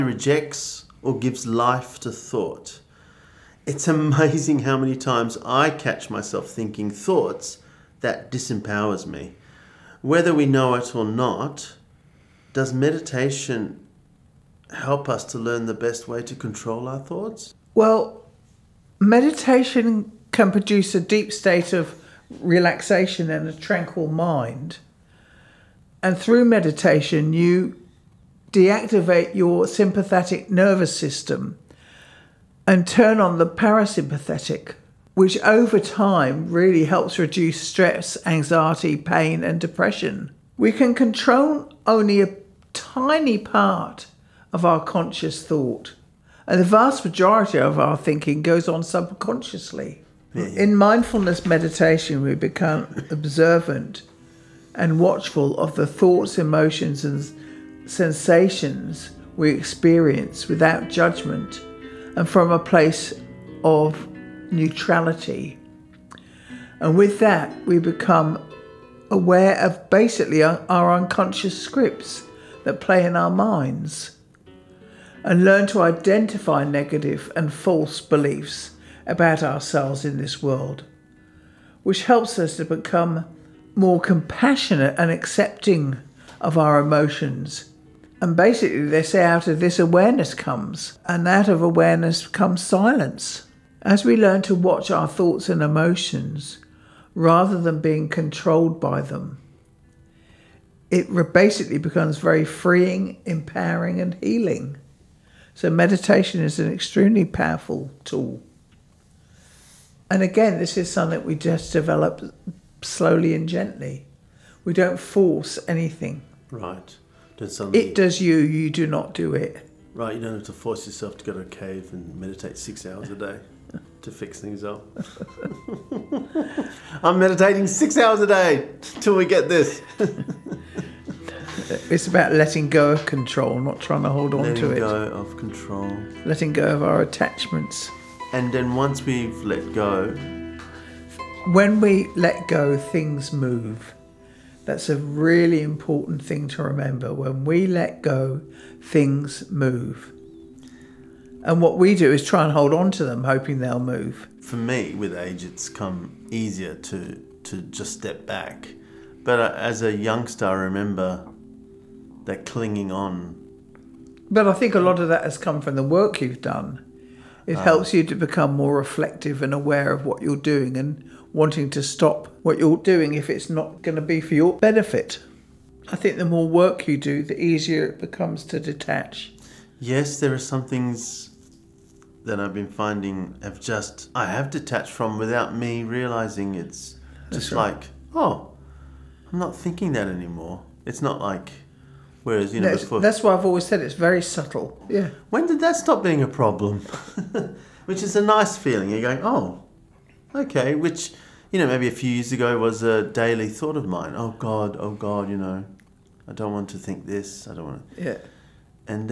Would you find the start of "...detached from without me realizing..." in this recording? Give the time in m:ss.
3:04.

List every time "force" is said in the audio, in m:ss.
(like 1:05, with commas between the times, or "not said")
1:54, 2:00.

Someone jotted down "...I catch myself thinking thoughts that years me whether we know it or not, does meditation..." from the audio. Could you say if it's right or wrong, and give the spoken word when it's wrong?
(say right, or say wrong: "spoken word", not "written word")
wrong: "disempowers", not "years".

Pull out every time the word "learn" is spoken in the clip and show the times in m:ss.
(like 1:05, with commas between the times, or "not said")
0:15, 1:15, 1:34.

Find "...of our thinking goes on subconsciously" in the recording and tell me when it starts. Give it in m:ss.
0:47.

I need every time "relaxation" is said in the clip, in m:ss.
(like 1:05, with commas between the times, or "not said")
0:22.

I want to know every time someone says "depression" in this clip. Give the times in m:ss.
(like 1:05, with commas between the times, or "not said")
0:39.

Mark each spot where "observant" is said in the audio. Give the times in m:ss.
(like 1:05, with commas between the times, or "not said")
0:53.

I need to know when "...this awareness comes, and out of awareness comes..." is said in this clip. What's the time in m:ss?
1:29.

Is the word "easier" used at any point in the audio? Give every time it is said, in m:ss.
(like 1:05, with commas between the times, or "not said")
2:36, 2:57.